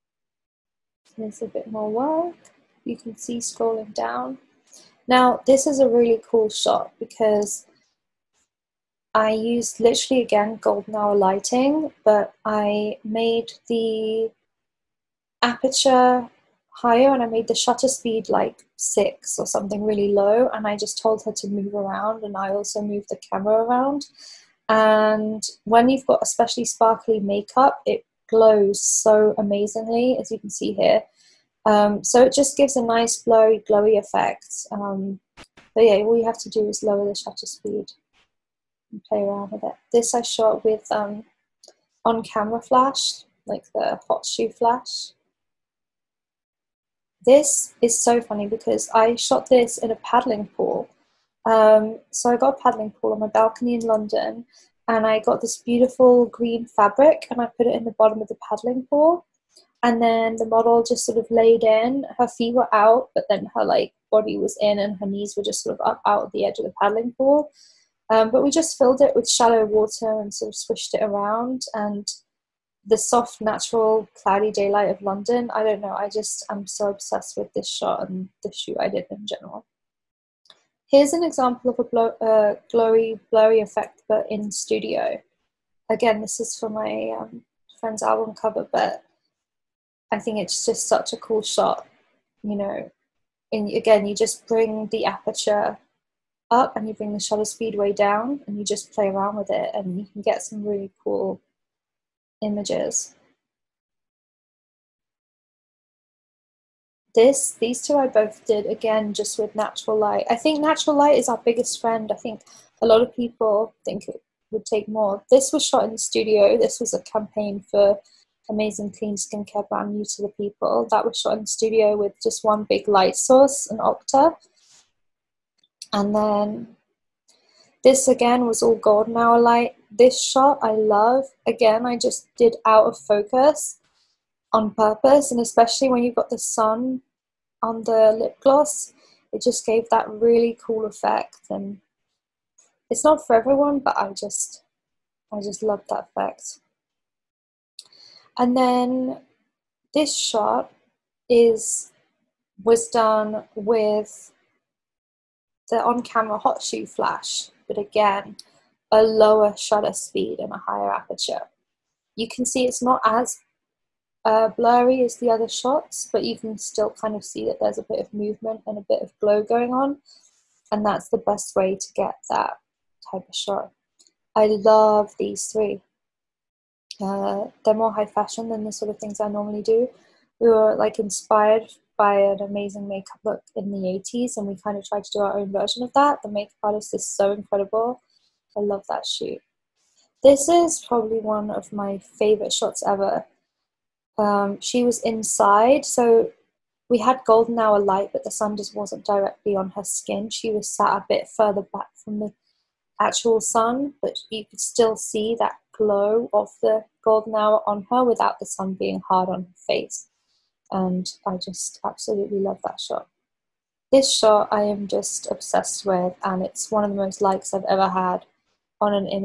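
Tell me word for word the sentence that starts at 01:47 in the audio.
This, these two I both did again just with natural light.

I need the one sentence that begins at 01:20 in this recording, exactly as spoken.
Here's an example of a blow, uh, glowy, blurry effect, but in studio.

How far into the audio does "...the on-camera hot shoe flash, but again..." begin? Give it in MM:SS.
02:35.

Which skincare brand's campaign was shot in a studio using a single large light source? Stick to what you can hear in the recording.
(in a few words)
Youth to the People.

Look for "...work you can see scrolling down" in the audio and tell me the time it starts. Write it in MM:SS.
00:01.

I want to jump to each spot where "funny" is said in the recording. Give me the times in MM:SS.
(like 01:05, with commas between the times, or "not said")
00:48.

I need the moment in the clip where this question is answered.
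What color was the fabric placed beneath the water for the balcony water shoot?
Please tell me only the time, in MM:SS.
00:56.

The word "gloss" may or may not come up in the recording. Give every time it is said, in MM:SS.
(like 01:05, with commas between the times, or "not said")
02:18.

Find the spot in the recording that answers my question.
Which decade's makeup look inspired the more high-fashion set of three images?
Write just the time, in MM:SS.
03:03.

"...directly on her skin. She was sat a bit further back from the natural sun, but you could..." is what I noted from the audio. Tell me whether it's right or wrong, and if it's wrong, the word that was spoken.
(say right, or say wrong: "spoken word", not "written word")
wrong: "actual", not "natural".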